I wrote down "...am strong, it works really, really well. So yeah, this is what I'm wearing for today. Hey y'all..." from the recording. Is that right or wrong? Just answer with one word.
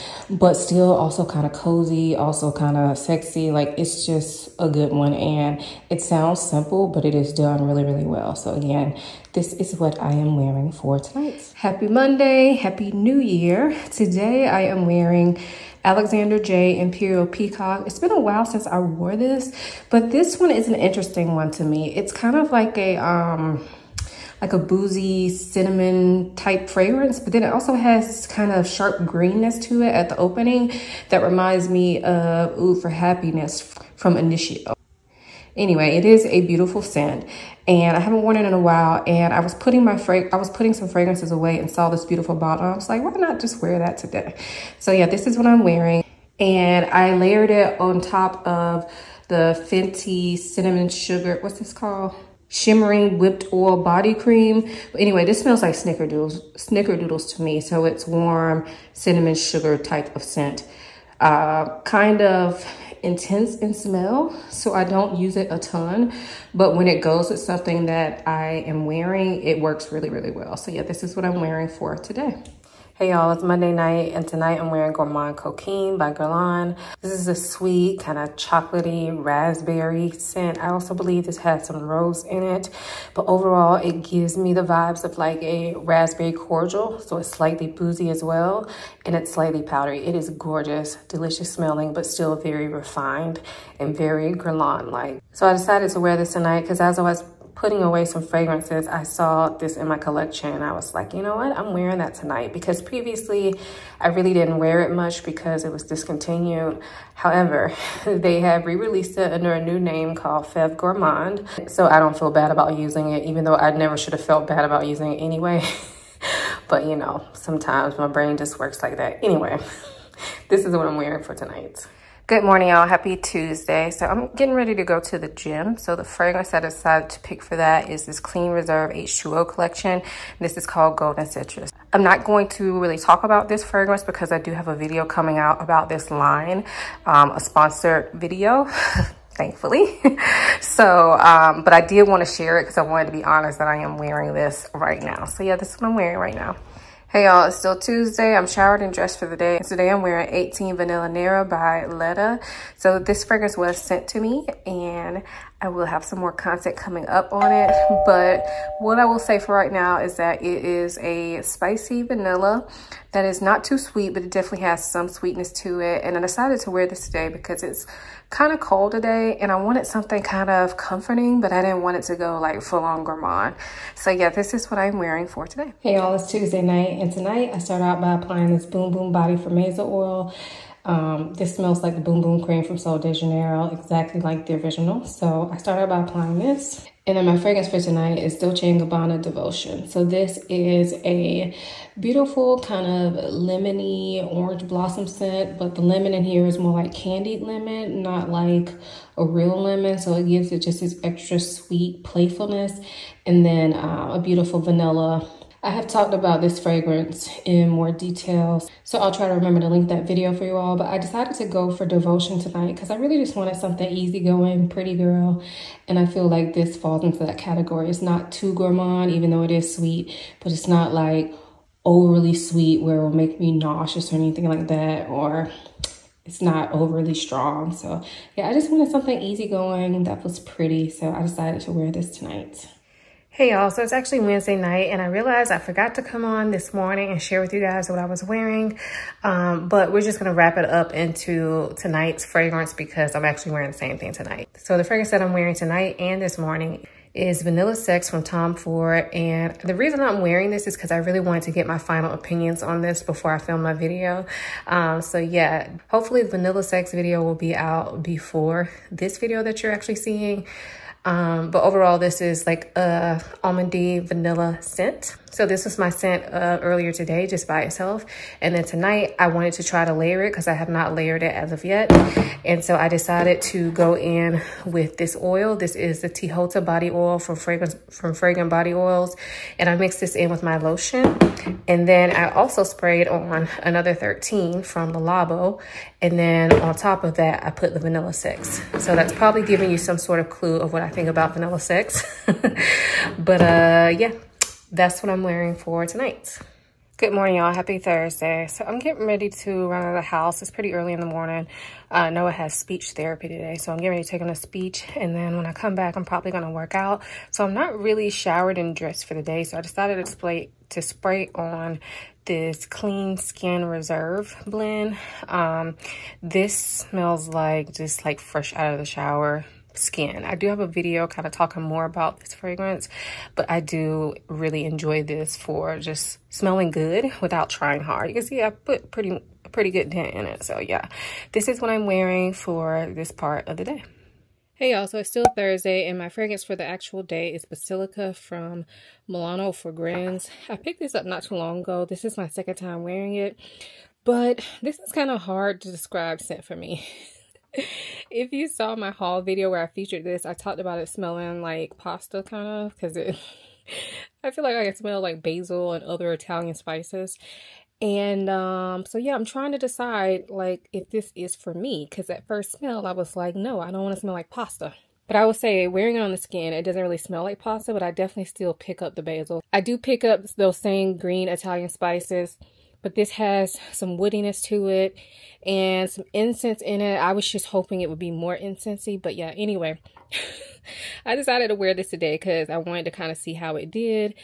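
wrong.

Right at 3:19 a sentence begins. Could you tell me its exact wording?
So it gives it just this extra sweet playfulness.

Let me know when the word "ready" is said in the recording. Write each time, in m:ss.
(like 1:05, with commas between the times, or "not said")
2:04, 4:59, 5:03.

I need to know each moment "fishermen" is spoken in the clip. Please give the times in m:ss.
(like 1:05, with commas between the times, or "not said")
not said.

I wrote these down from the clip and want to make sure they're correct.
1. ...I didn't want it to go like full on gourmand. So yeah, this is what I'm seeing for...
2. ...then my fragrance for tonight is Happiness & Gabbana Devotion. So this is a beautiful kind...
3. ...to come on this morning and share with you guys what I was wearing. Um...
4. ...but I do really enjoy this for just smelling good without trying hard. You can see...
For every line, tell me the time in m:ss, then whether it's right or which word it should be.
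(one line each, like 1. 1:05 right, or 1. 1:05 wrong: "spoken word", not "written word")
1. 2:51 wrong: "wearing", not "seeing"
2. 3:07 wrong: "Dolce", not "Happiness"
3. 3:55 right
4. 5:23 right.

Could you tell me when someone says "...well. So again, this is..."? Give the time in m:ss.
0:08.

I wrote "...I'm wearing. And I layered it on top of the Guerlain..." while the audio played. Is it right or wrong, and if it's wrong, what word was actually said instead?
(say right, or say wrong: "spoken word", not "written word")
wrong: "Fenty", not "Guerlain".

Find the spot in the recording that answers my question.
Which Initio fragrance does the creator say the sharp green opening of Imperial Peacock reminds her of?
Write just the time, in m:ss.
0:32.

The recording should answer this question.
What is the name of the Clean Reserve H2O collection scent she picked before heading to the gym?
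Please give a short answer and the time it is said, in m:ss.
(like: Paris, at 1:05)
Golden Citrus, at 2:10.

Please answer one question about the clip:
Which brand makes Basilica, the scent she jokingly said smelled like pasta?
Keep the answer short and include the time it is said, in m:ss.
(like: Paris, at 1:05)
Milano Fragrance, at 5:39.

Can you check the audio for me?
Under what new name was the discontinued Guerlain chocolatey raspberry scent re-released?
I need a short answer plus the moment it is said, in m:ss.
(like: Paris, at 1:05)
Fève Gourmand, at 1:50.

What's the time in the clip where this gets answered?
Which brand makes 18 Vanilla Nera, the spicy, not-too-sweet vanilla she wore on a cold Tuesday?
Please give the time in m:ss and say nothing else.
2:31.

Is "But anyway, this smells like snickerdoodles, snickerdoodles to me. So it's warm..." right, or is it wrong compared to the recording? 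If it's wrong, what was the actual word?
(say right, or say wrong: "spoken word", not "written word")
right.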